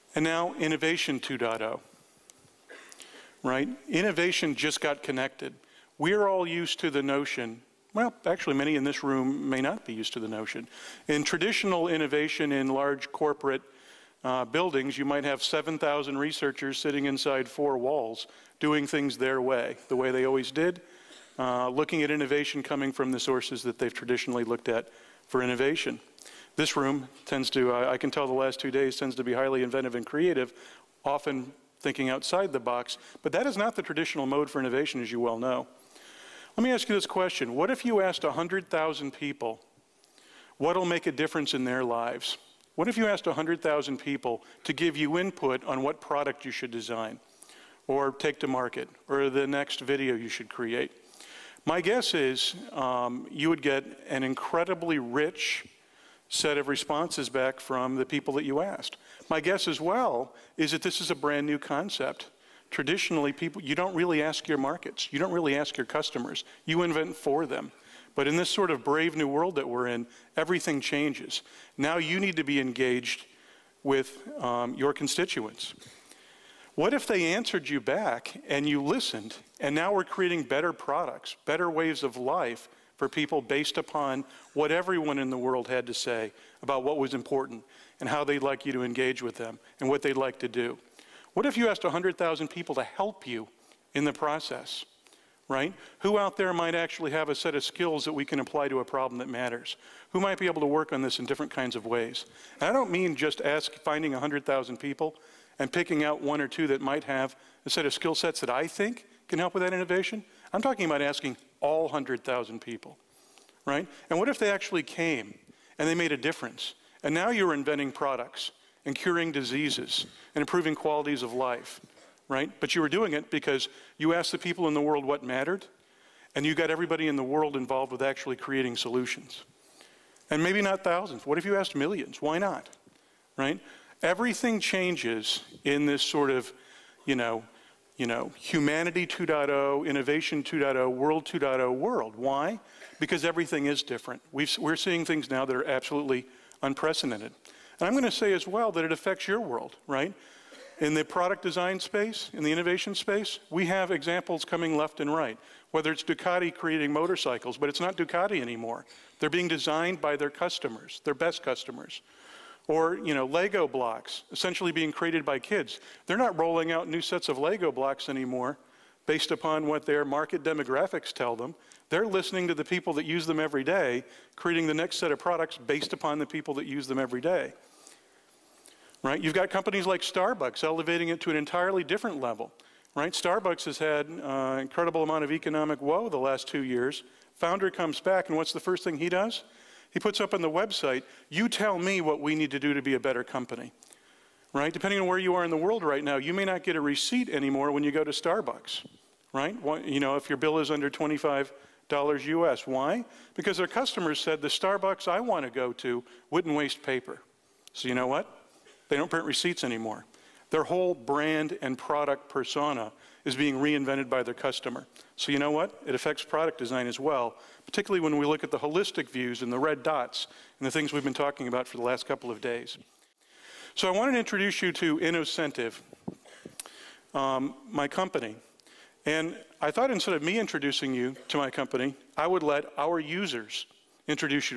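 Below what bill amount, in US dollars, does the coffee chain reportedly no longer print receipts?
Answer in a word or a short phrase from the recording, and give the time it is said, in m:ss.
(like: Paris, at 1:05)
25 dollars, at 3:20.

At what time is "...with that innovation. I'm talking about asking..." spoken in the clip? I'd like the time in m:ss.
1:49.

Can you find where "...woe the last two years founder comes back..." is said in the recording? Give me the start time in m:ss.
3:05.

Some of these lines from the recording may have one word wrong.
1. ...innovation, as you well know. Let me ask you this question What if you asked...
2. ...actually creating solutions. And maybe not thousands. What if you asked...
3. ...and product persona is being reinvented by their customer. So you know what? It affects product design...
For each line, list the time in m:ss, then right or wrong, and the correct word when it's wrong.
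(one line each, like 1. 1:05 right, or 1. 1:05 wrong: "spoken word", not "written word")
1. 0:34 right
2. 2:08 right
3. 3:31 right.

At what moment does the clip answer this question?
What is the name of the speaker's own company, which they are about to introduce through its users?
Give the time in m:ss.
3:44.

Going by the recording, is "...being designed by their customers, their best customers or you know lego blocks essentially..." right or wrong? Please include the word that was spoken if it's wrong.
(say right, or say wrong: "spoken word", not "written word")
right.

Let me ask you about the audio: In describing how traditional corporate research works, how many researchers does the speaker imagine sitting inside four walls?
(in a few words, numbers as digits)
7,000.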